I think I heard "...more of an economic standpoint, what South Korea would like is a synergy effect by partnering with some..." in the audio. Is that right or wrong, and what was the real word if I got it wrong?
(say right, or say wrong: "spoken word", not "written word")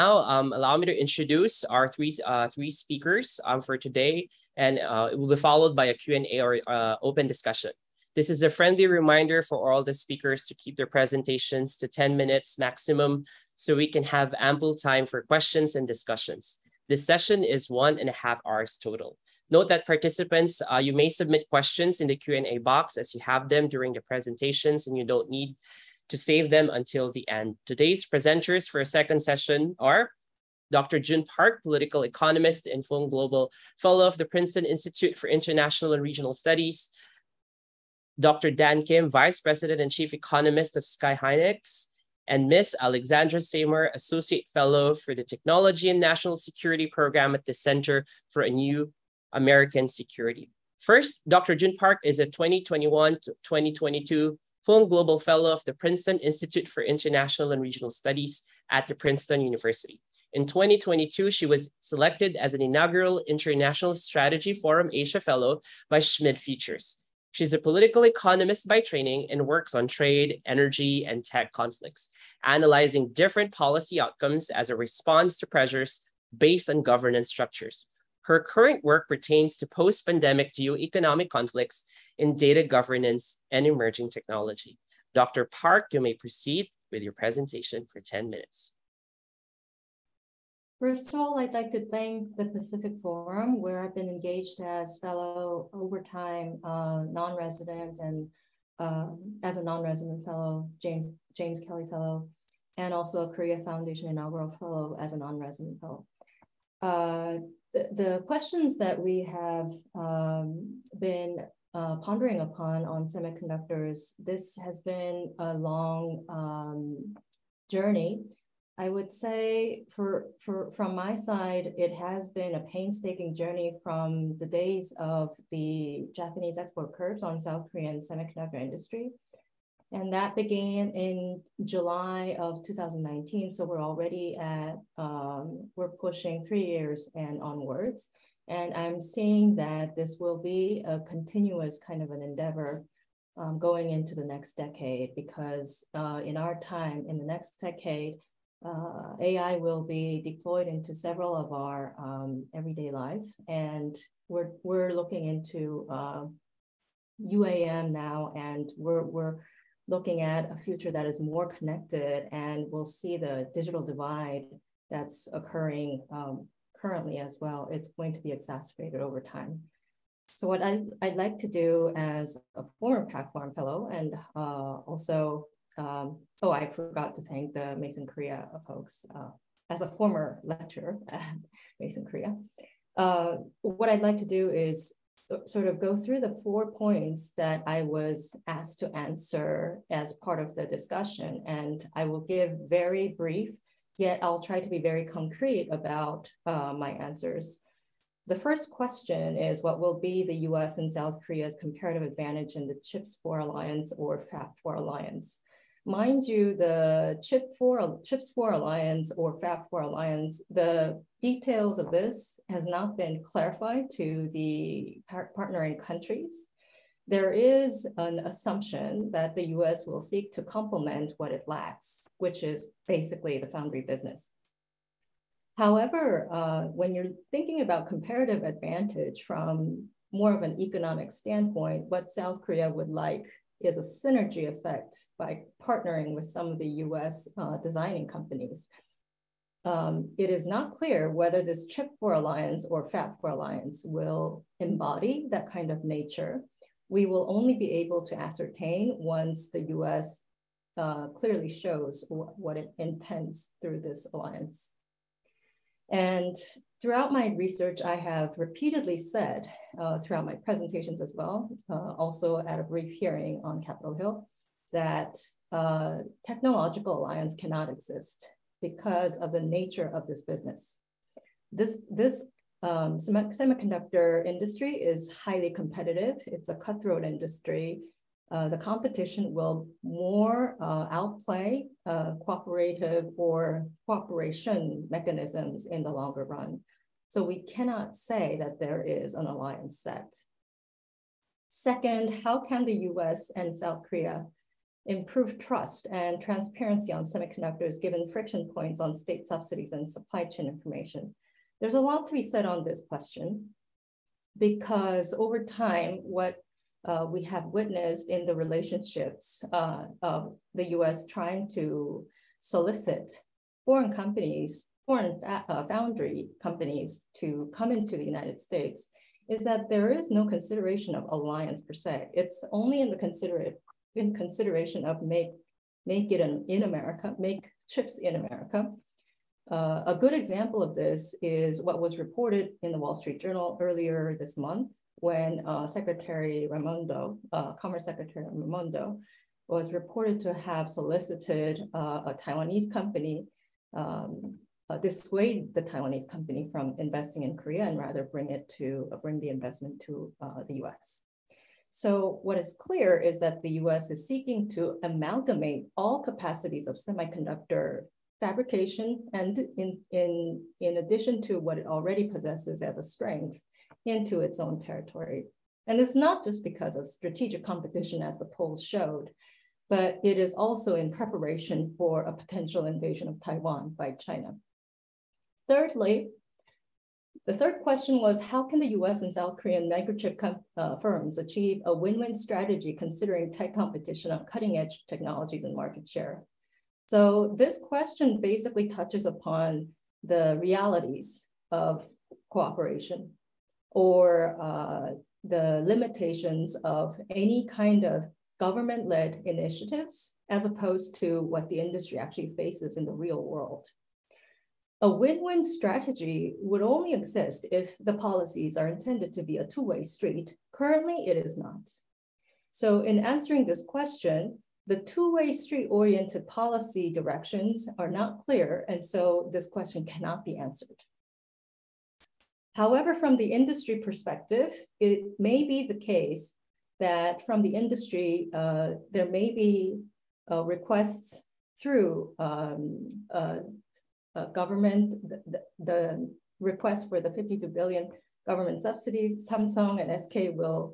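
right.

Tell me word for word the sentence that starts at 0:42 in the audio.
Alexandra Seymour, Associate Fellow for the Technology and National Security Program at the Center for a New American security.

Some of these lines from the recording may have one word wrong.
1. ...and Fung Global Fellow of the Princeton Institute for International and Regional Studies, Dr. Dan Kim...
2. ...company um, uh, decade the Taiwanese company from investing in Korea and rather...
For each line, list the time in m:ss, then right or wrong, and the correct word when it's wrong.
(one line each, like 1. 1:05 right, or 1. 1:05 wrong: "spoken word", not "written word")
1. 0:32 right
2. 5:42 wrong: "dissuade", not "decade".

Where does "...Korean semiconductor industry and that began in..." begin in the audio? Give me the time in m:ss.
2:07.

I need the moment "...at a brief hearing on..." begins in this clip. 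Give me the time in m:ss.
4:22.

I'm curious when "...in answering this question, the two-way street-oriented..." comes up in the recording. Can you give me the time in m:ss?
6:52.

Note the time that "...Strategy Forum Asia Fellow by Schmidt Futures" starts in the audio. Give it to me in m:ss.
1:03.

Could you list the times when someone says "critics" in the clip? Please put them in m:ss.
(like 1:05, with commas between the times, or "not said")
not said.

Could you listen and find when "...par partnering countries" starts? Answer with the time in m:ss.
3:35.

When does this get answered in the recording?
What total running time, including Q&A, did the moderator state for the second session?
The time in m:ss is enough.
0:17.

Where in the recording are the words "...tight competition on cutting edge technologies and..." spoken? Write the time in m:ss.
6:23.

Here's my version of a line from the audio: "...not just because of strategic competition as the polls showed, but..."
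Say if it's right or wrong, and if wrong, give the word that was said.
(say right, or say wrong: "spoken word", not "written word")
right.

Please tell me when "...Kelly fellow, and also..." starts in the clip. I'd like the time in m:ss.
1:41.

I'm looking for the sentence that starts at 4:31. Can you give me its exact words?
This, this um, semiconductor industry is highly competitive.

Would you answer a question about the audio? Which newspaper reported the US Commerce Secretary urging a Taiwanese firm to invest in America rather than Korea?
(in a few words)
Wall Street Journal.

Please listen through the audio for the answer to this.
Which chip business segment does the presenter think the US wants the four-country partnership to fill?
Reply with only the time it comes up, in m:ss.
3:43.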